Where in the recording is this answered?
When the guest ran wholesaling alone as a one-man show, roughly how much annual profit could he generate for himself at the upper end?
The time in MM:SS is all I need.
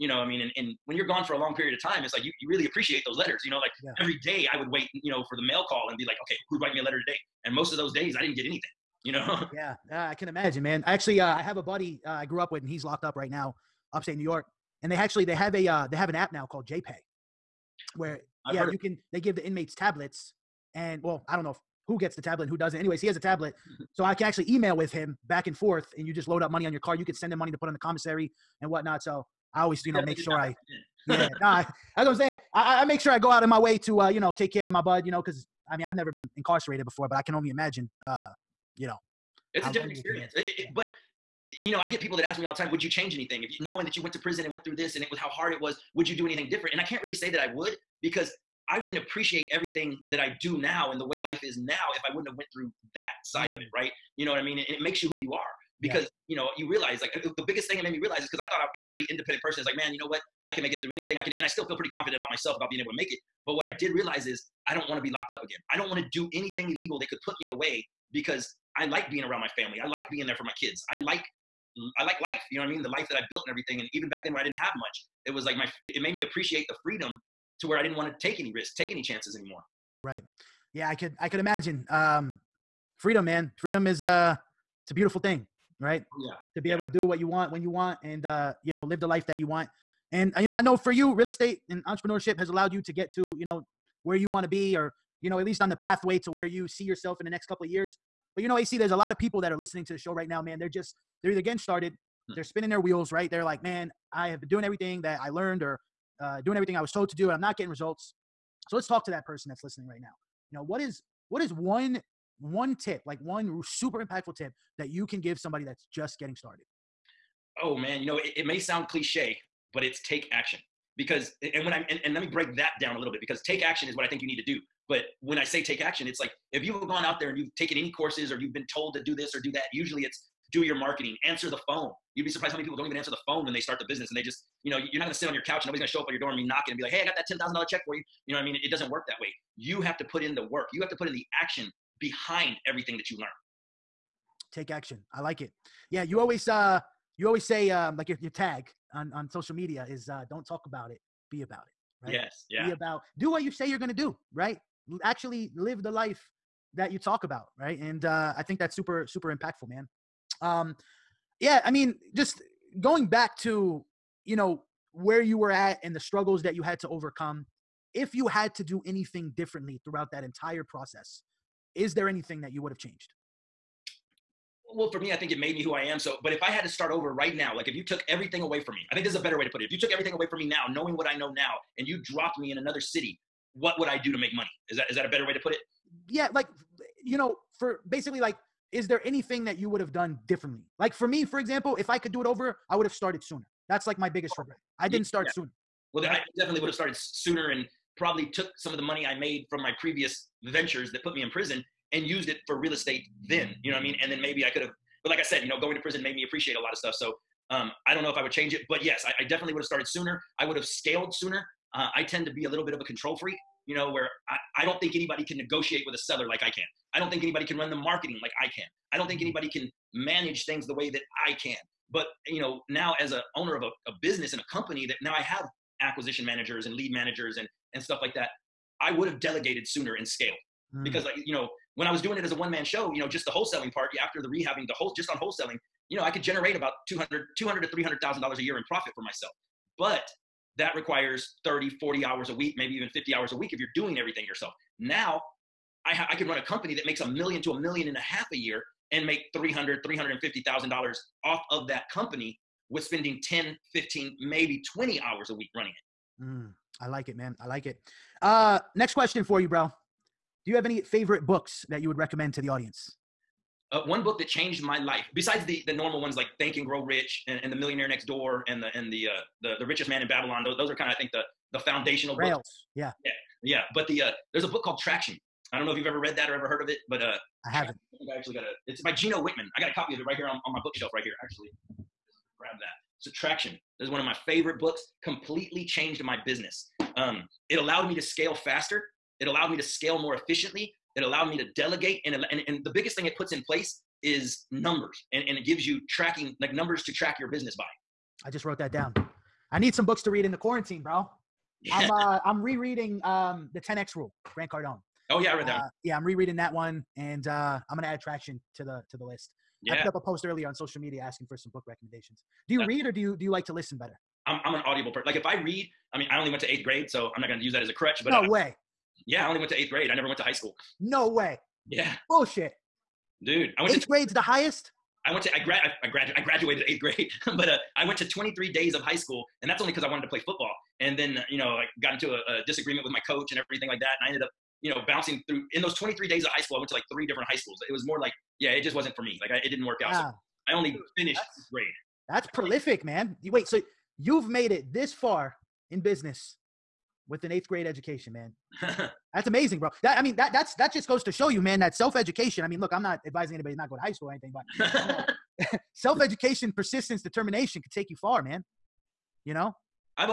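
03:57.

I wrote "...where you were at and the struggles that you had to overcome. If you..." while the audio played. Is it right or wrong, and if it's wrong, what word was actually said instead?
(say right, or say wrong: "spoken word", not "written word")
right.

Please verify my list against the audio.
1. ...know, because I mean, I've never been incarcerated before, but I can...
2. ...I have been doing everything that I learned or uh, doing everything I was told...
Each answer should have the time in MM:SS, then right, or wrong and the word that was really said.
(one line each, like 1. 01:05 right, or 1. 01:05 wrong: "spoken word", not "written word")
1. 00:35 right
2. 01:44 right.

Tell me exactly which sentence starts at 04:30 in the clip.
Those those are kind of I think the the foundational Rails.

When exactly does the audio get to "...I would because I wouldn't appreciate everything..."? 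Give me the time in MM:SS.
00:47.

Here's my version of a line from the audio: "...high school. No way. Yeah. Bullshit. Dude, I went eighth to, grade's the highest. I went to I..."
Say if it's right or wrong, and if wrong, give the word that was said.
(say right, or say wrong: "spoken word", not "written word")
right.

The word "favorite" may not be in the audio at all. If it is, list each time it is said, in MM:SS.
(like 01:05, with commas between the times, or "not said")
04:20, 04:44.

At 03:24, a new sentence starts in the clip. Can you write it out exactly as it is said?
And then maybe I could have, but like I said, you know, going to prison made me appreciate a lot of stuff.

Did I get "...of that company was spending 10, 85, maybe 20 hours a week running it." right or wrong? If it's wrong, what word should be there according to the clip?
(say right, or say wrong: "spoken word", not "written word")
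wrong: "15", not "85".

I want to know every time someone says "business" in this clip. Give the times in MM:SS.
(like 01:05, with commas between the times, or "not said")
02:13, 03:44, 04:46, 04:57, 05:45.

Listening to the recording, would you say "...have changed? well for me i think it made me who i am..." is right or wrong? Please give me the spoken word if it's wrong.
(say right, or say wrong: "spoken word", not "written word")
right.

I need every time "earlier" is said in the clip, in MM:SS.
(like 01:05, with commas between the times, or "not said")
05:10.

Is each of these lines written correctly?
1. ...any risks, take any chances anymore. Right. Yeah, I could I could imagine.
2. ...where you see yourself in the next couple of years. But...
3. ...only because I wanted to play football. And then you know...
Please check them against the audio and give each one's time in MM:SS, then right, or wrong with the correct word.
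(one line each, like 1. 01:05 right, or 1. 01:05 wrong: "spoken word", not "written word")
1. 01:18 right
2. 01:36 right
3. 05:29 right.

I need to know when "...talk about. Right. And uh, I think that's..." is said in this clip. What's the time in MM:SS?
02:36.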